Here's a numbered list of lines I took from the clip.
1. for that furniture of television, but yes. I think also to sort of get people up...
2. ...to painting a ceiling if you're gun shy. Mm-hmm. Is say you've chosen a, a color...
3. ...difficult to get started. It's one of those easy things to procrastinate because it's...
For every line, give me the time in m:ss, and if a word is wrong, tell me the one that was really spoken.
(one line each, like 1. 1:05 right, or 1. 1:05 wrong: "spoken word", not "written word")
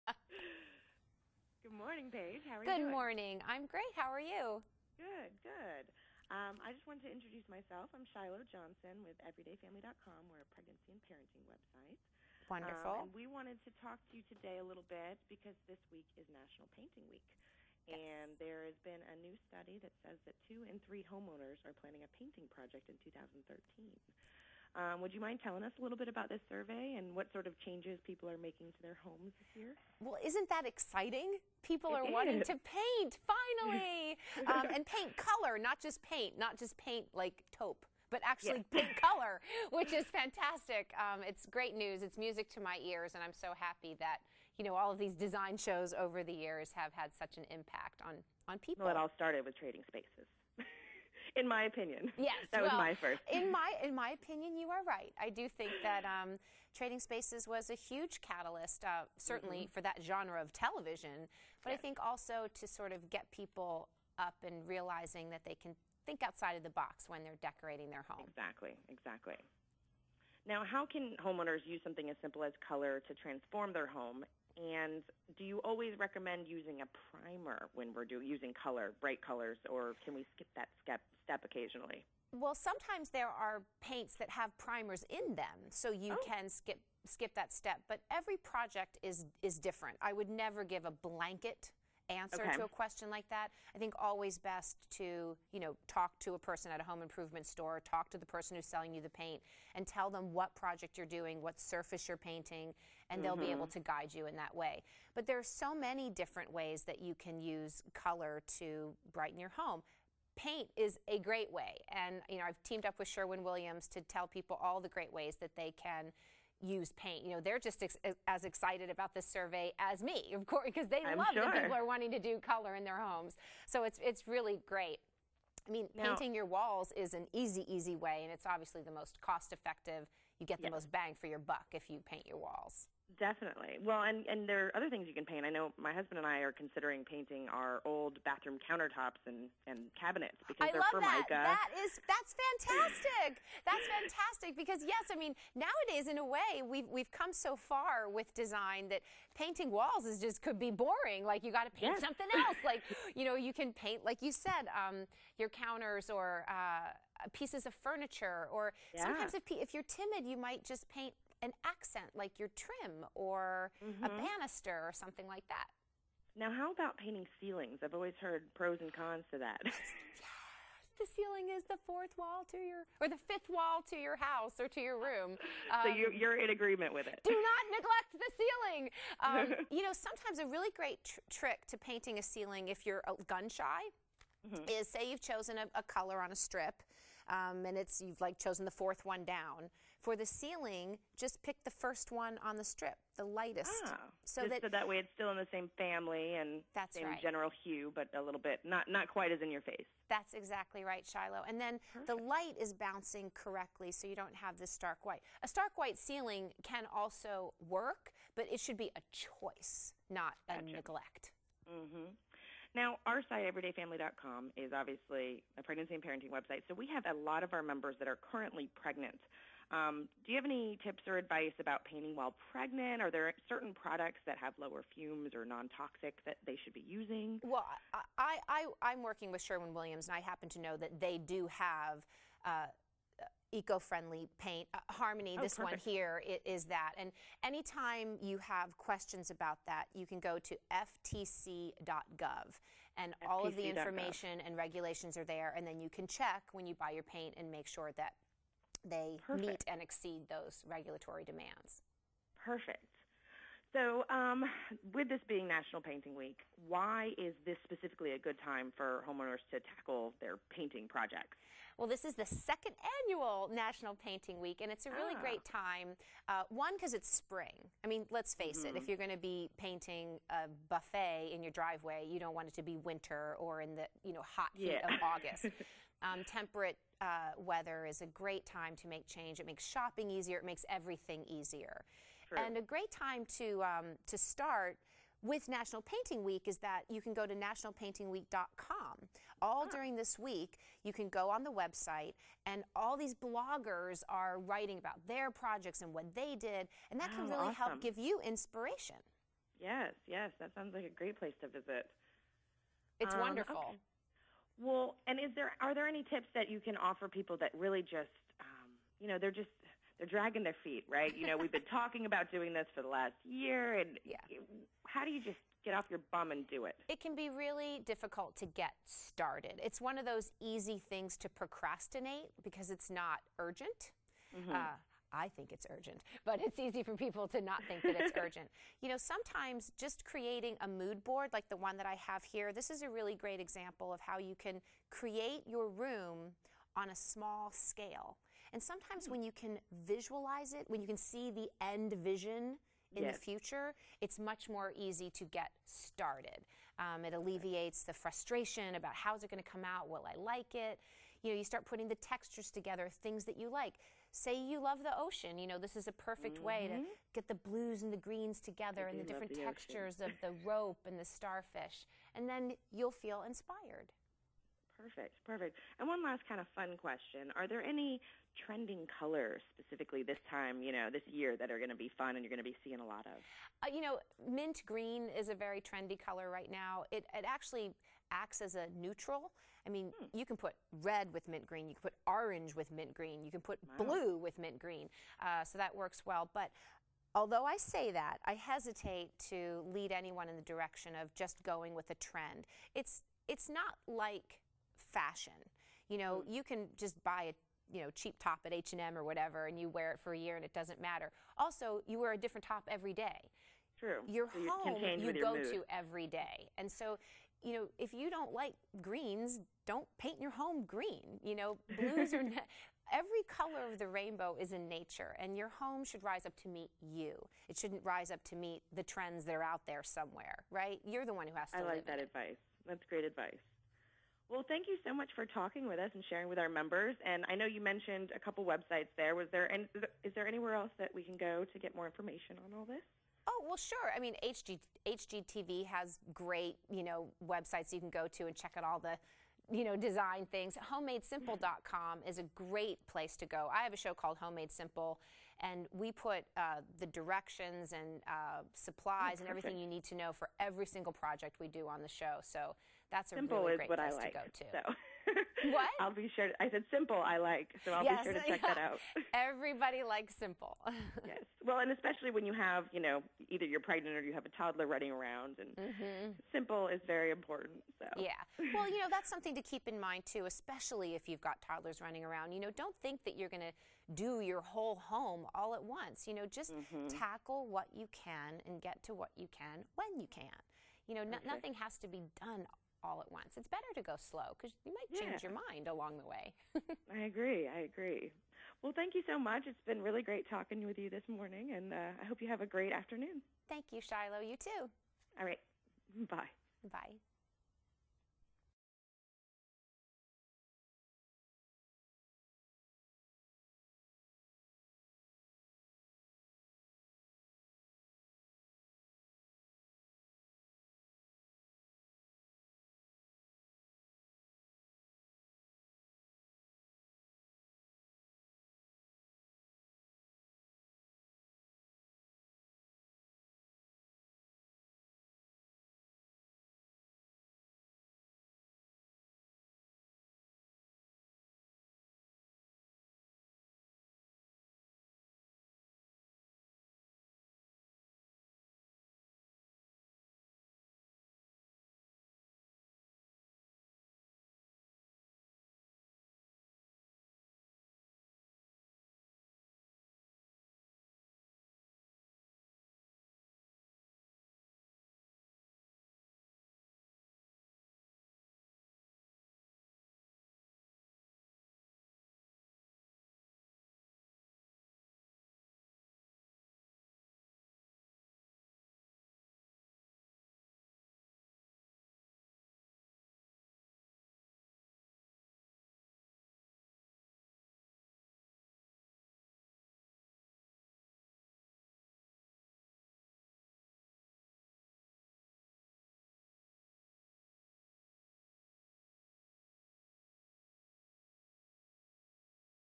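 1. 0:59 wrong: "genre", not "furniture"
2. 3:01 right
3. 5:17 right.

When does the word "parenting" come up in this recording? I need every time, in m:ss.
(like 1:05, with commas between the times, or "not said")
0:11, 3:36.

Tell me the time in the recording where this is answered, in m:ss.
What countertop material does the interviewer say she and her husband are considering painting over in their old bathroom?
2:20.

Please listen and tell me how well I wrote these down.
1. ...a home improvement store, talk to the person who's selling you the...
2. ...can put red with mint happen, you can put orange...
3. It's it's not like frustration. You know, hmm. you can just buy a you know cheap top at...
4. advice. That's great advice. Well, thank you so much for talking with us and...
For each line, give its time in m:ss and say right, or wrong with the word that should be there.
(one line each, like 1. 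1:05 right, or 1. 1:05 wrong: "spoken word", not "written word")
1. 1:36 right
2. 6:20 wrong: "green", not "happen"
3. 6:32 wrong: "fashion", not "frustration"
4. 7:02 right.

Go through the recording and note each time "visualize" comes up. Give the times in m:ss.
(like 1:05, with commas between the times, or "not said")
5:39.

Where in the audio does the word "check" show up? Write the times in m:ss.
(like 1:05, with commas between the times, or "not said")
4:06, 7:18, 7:38.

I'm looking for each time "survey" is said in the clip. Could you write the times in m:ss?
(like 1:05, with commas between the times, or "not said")
0:26, 1:59.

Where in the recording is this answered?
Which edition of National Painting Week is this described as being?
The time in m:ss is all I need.
4:22.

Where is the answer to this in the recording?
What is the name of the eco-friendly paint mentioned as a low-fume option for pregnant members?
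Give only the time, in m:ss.
3:54.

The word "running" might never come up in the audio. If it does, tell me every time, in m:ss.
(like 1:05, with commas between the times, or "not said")
7:44, 7:51.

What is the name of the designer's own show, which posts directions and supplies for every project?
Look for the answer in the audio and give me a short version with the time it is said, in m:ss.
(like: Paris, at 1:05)
Homemade Simple, at 7:24.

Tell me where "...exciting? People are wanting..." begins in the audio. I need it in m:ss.
0:30.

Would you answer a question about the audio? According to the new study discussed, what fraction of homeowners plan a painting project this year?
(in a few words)
2 in 3.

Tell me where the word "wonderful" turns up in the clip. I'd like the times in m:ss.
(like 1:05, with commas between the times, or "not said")
0:12, 5:03.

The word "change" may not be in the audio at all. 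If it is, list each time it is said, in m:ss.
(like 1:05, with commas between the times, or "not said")
0:27, 4:39, 8:04.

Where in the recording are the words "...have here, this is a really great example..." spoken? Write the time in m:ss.
5:32.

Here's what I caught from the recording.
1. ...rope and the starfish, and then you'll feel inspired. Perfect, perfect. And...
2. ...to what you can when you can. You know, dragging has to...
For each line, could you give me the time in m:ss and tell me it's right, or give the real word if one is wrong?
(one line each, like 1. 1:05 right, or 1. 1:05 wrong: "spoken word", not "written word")
1. 6:00 right
2. 7:58 wrong: "nothing", not "dragging".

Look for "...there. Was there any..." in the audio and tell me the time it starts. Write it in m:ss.
7:08.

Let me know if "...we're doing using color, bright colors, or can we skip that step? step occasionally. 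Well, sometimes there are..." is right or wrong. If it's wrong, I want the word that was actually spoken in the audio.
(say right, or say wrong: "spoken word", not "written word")
right.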